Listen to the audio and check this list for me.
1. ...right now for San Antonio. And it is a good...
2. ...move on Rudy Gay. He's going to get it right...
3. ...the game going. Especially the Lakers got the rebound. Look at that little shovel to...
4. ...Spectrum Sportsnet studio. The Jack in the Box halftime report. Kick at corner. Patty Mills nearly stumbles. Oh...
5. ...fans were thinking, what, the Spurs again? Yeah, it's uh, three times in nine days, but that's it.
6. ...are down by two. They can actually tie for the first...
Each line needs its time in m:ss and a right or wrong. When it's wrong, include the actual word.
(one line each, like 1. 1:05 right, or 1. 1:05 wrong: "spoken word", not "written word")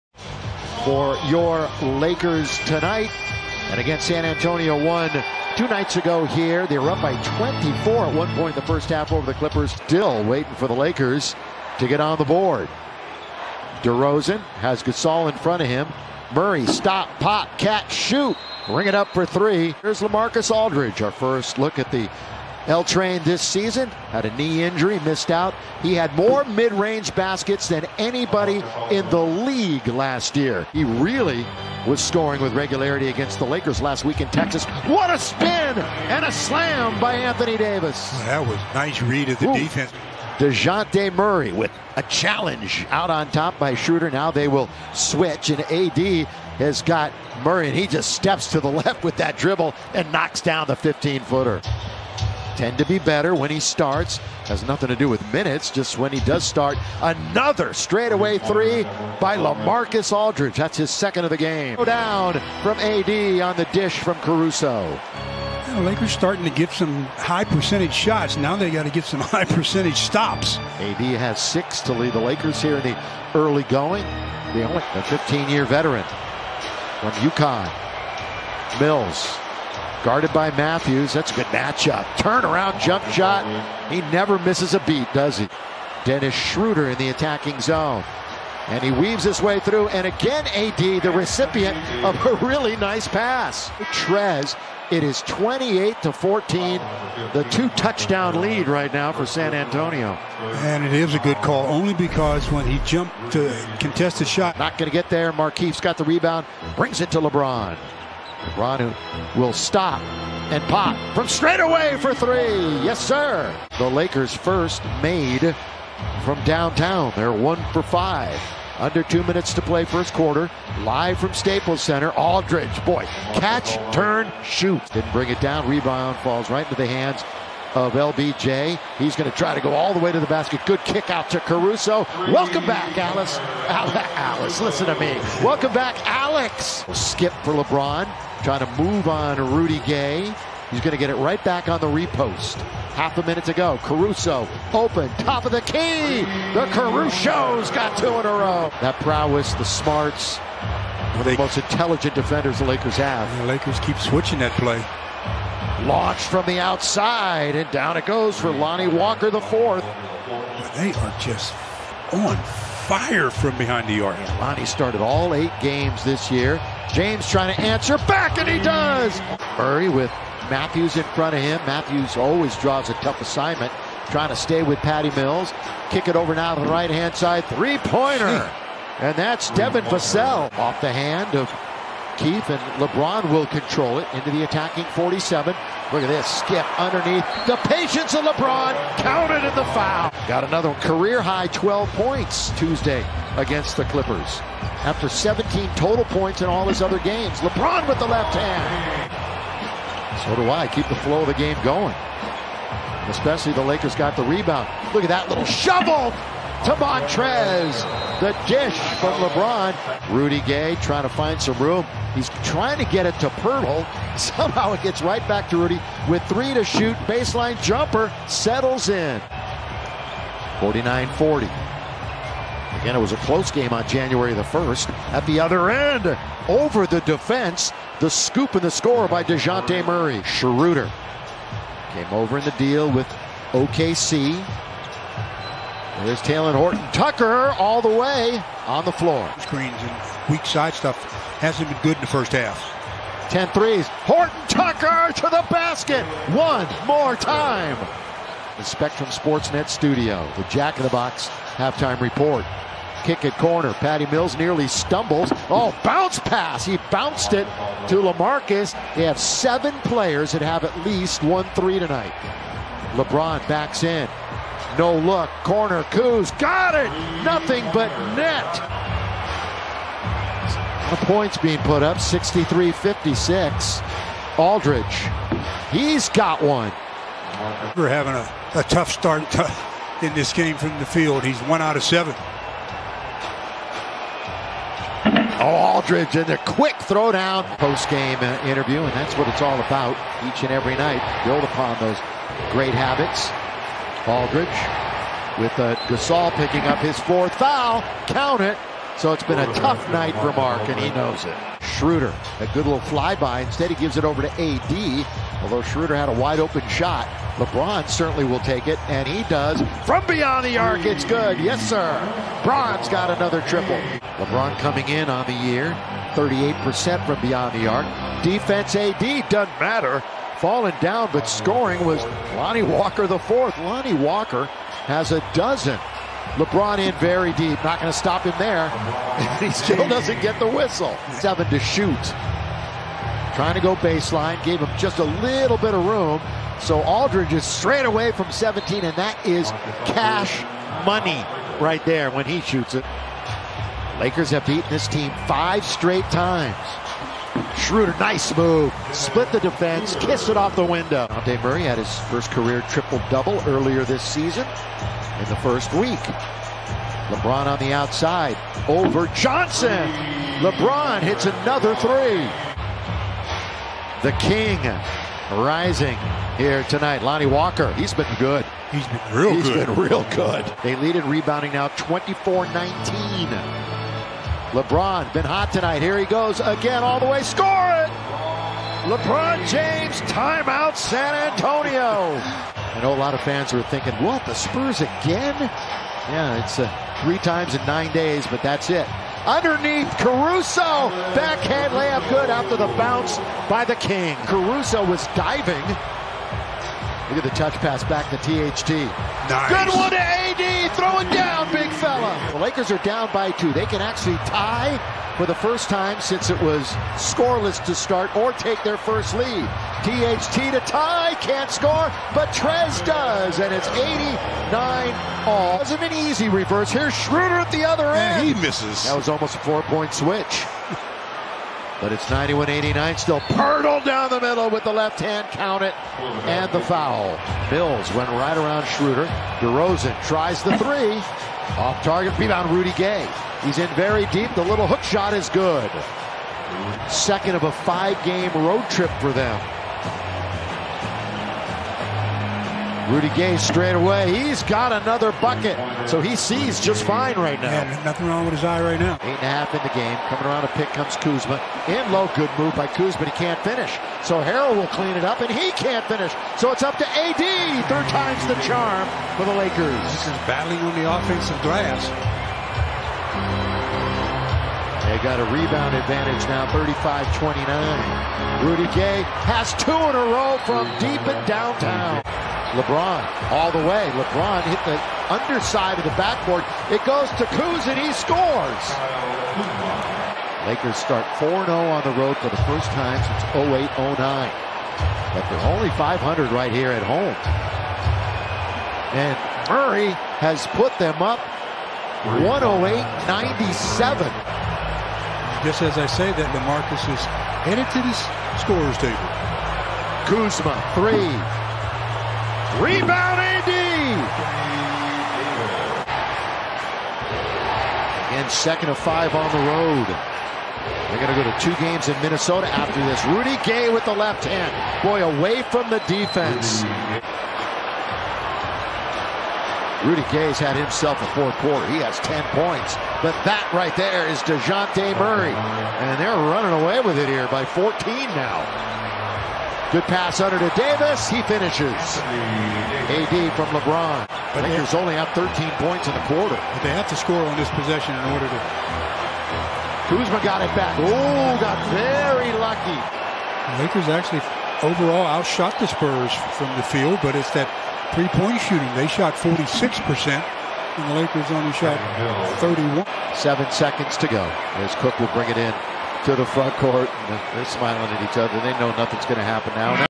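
1. 1:38 right
2. 2:18 right
3. 3:21 right
4. 4:08 right
5. 6:23 right
6. 6:42 right.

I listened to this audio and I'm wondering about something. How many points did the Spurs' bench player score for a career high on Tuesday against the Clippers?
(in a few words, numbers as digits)
12.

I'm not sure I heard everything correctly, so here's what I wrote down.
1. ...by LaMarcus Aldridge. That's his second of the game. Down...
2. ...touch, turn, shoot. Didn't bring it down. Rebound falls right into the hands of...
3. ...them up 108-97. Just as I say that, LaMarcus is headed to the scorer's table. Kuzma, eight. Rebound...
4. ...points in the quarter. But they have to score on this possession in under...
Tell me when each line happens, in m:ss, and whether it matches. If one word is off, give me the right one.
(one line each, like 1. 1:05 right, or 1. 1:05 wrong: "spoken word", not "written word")
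1. 0:59 right
2. 2:03 wrong: "catch", not "touch"
3. 8:10 wrong: "three", not "eight"
4. 8:55 wrong: "order", not "under".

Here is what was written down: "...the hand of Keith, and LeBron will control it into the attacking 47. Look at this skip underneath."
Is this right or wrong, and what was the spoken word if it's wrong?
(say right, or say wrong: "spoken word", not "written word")
right.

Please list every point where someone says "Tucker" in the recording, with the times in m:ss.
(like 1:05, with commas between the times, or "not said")
3:56, 4:04.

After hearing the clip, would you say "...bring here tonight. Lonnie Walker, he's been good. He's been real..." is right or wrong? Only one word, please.
wrong.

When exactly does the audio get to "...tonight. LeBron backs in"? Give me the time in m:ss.
4:21.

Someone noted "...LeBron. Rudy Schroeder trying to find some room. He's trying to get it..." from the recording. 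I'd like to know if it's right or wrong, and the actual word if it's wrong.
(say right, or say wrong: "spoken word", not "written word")
wrong: "Gay", not "Schroeder".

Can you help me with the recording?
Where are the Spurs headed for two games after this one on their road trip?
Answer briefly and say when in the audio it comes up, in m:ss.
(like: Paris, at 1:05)
Minnesota, at 8:32.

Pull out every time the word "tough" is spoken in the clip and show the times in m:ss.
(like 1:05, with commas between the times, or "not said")
2:52, 4:38, 4:59.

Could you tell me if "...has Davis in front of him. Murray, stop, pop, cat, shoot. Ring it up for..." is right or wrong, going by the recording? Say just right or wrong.
wrong.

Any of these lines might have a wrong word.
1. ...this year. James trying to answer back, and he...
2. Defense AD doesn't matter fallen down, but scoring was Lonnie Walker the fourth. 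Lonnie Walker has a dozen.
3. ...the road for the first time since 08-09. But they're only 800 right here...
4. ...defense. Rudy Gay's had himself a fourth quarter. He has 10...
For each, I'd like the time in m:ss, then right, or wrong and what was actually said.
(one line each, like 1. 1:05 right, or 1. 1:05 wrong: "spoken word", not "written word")
1. 2:46 right
2. 5:18 right
3. 8:01 wrong: "500", not "800"
4. 8:35 right.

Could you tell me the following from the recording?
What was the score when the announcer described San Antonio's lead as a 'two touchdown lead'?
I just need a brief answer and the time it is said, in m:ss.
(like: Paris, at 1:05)
28 to 14, at 1:35.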